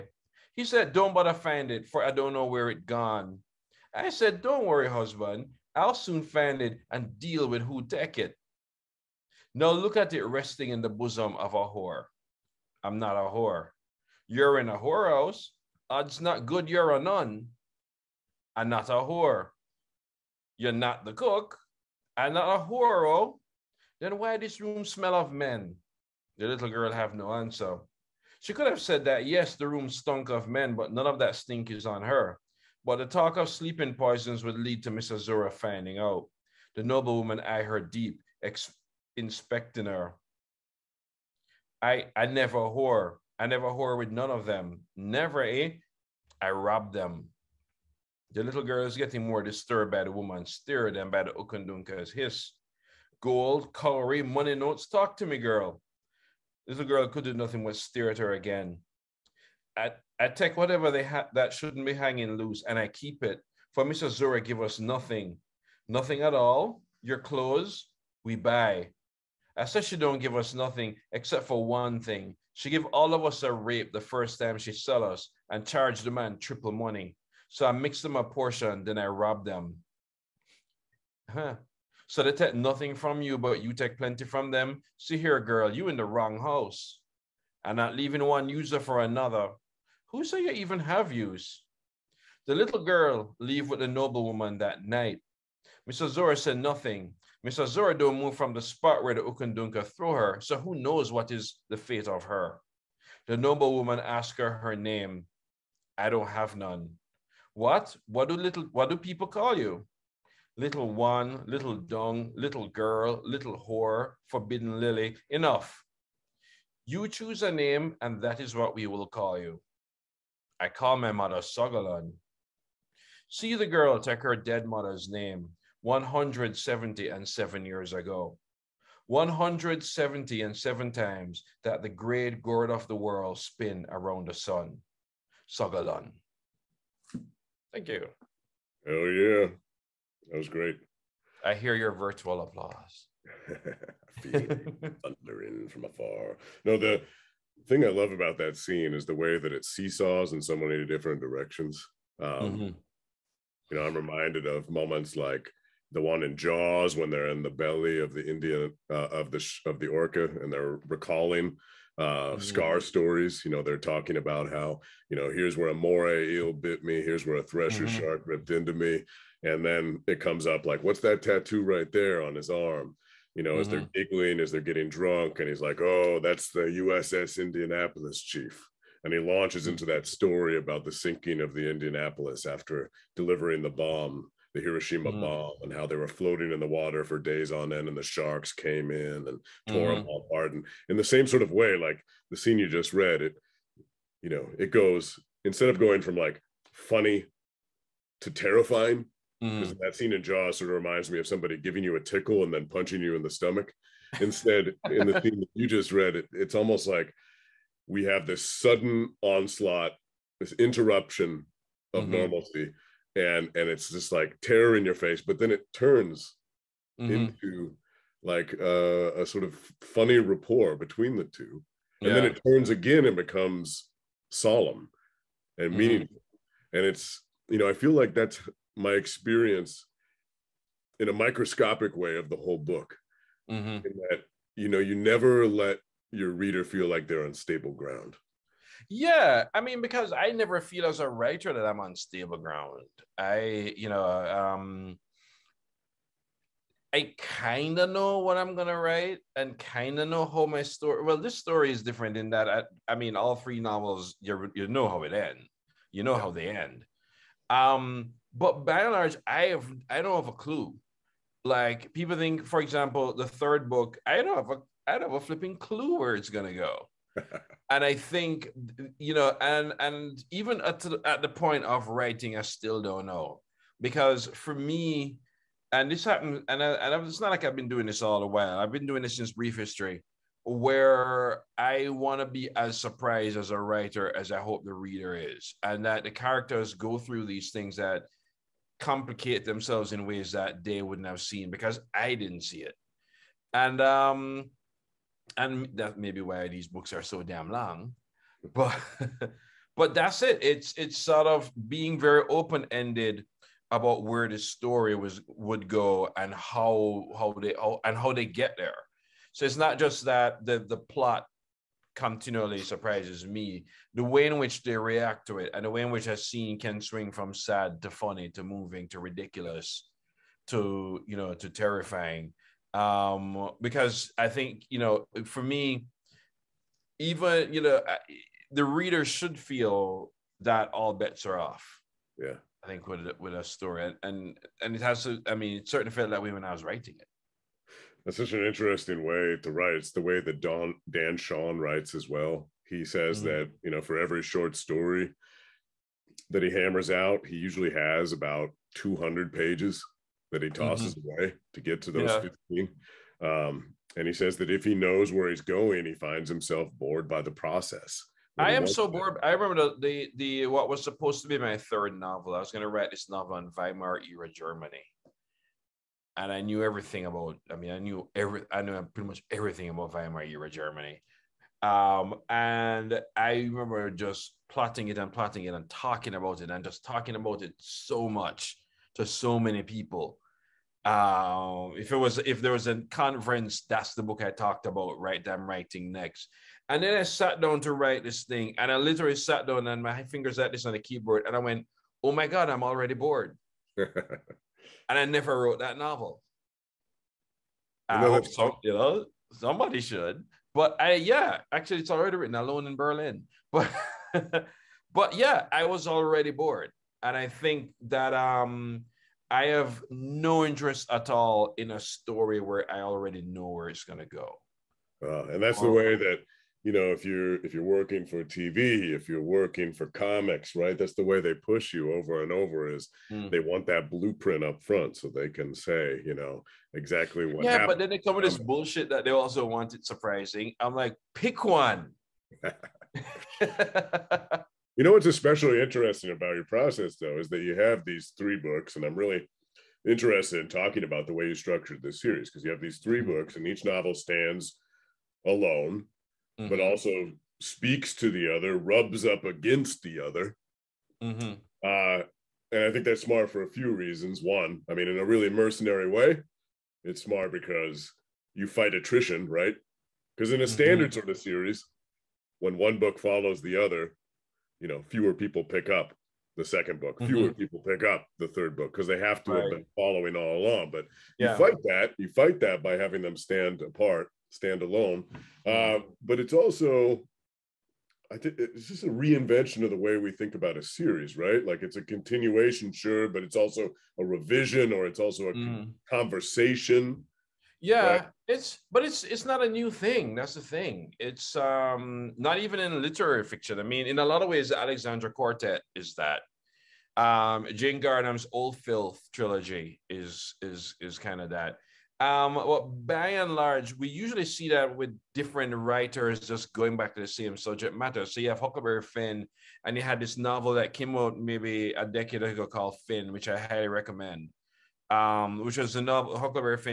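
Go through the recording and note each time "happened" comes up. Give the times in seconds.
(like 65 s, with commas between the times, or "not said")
276 s, 427 s.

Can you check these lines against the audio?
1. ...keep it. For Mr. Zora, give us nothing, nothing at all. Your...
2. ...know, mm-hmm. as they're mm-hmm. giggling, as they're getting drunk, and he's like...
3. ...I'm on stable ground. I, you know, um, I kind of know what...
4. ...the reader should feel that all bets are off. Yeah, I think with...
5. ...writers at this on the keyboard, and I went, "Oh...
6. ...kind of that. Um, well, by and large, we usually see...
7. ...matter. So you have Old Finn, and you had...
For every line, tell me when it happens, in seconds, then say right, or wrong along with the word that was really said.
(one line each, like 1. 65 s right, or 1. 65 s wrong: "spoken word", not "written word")
1. 62 s right
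2. 173 s right
3. 241 s right
4. 328 s right
5. 390 s wrong: "fingers", not "writers"
6. 500 s right
7. 507 s wrong: "Huckleberry", not "Old".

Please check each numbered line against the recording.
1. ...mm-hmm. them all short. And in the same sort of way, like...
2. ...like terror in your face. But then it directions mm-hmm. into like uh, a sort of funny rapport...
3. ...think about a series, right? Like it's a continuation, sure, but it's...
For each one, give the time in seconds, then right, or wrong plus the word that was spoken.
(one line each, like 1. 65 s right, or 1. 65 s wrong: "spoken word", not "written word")
1. 189 s wrong: "apart", not "short"
2. 214 s wrong: "turns", not "directions"
3. 480 s right.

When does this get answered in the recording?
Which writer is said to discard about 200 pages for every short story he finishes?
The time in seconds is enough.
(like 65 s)
340 s.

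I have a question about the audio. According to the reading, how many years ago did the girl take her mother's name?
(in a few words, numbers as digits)
177.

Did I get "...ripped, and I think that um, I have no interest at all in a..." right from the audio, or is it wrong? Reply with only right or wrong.
wrong.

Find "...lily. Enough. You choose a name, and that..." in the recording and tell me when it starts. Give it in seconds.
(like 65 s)
114 s.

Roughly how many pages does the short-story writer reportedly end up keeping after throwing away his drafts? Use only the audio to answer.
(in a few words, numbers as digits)
15.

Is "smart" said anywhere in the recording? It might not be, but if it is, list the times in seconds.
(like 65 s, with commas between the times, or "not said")
453 s, 457 s.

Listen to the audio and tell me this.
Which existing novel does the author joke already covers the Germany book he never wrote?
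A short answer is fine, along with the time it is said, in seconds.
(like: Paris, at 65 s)
Alone in Berlin, at 402 s.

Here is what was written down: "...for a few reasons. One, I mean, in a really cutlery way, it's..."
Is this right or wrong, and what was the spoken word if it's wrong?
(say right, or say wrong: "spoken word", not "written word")
wrong: "mercenary", not "cutlery".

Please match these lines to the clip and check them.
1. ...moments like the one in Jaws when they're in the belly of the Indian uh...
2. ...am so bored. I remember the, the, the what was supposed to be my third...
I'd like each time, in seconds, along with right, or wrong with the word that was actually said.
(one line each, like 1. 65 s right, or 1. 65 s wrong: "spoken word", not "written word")
1. 154 s right
2. 358 s right.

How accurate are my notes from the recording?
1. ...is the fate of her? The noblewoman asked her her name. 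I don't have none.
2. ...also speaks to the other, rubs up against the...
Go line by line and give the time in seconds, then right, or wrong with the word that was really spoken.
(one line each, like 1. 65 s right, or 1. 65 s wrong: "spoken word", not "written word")
1. 101 s right
2. 446 s right.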